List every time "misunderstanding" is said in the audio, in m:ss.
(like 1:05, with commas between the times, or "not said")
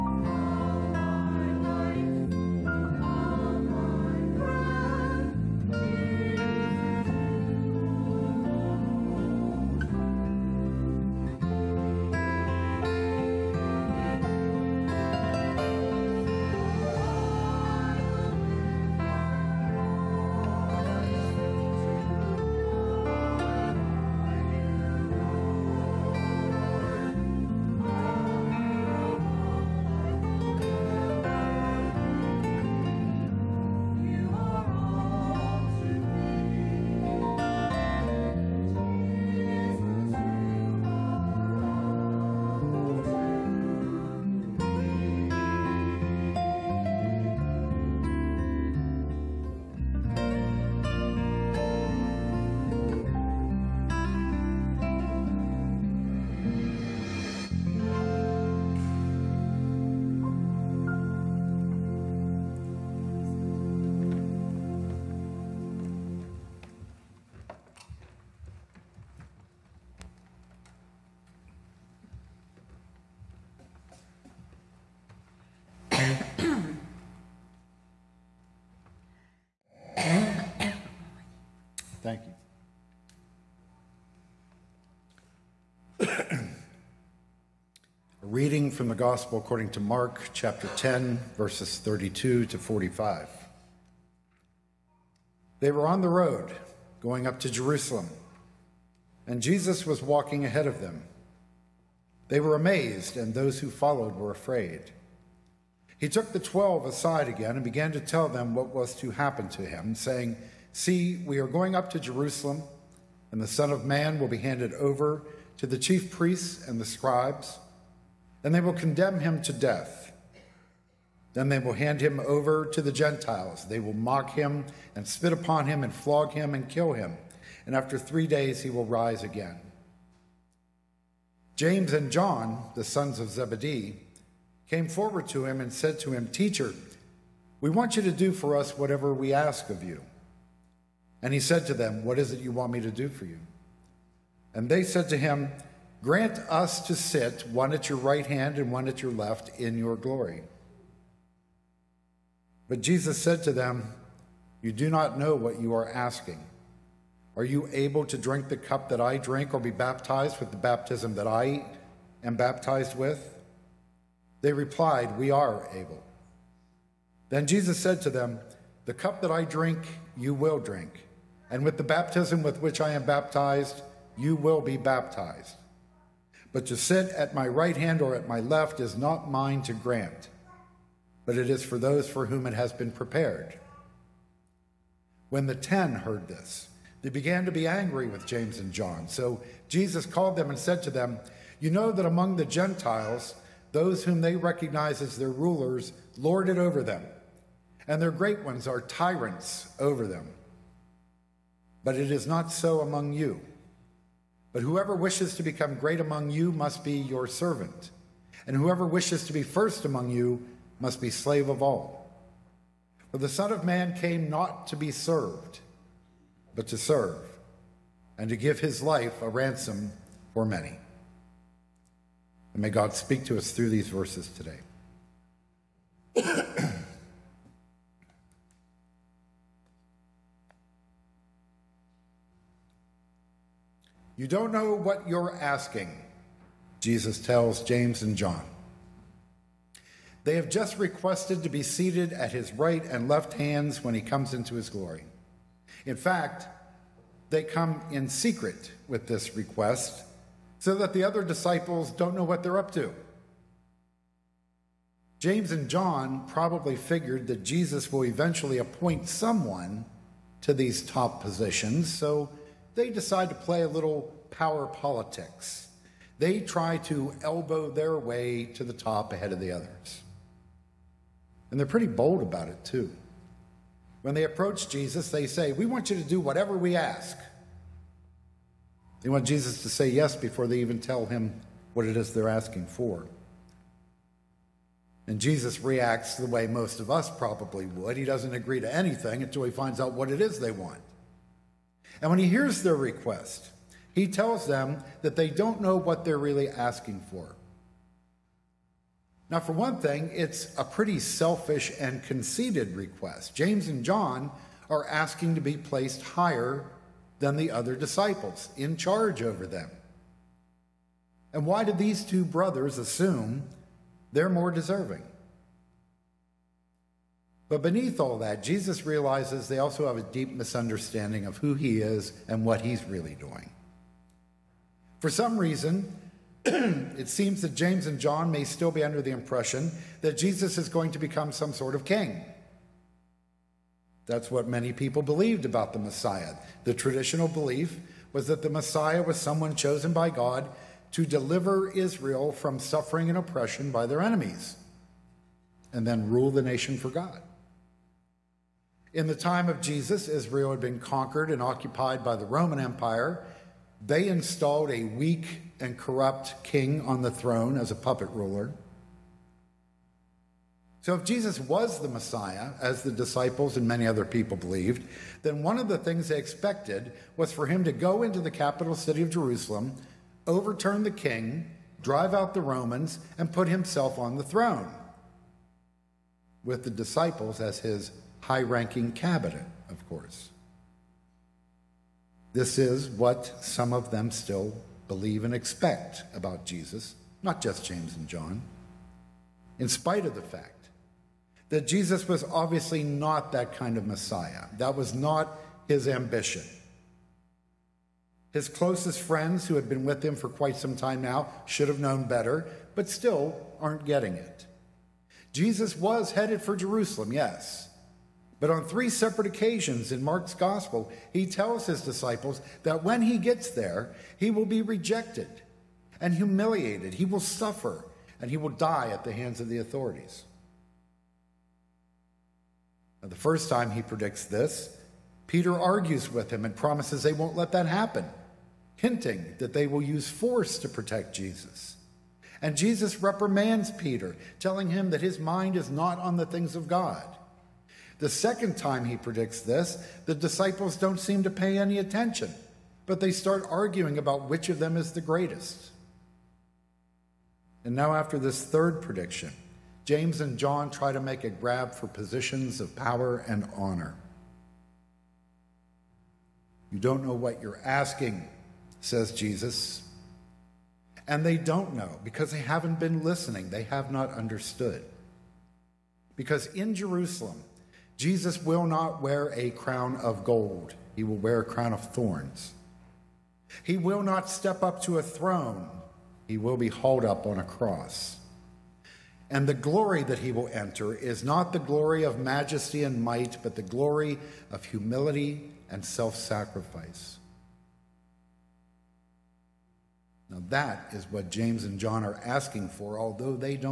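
5:20.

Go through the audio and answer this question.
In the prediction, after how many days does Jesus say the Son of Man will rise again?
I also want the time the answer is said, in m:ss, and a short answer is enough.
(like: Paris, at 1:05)
3, at 2:07.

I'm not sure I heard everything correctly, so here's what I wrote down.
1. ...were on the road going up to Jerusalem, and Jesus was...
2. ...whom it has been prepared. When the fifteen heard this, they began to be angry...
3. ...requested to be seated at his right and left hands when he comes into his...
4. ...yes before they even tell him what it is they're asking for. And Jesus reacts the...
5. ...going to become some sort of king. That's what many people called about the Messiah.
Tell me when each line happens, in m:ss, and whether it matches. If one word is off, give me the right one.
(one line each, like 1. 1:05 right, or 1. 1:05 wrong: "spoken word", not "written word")
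1. 1:35 right
2. 3:02 wrong: "ten", not "fifteen"
3. 4:00 right
4. 4:39 right
5. 5:30 wrong: "believed", not "called".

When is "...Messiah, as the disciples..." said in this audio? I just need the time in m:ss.
6:01.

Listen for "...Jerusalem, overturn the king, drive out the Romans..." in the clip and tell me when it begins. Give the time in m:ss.
6:09.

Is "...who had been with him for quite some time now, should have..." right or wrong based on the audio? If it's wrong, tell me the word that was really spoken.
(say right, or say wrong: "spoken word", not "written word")
right.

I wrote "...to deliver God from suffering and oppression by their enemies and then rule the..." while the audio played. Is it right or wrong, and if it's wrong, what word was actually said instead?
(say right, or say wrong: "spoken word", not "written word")
wrong: "Israel", not "God".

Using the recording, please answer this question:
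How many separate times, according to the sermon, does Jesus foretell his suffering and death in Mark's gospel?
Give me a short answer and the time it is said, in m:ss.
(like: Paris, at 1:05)
3, at 6:48.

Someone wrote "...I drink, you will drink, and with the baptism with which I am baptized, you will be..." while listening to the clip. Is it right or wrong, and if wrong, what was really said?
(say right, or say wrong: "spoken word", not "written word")
right.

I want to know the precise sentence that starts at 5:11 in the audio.
And why do these two brothers assume they're more deserving?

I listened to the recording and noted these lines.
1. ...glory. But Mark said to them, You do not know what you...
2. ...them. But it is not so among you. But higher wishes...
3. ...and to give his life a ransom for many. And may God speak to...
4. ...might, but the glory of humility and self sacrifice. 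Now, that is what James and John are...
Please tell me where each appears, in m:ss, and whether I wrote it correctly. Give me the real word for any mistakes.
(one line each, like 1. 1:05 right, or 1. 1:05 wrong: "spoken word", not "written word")
1. 2:29 wrong: "Jesus", not "Mark"
2. 3:20 wrong: "whoever", not "higher"
3. 3:38 right
4. 8:03 right.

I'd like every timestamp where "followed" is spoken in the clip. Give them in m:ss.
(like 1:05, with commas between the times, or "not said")
1:43.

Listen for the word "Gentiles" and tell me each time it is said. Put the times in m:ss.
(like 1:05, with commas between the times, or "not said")
2:02, 3:12.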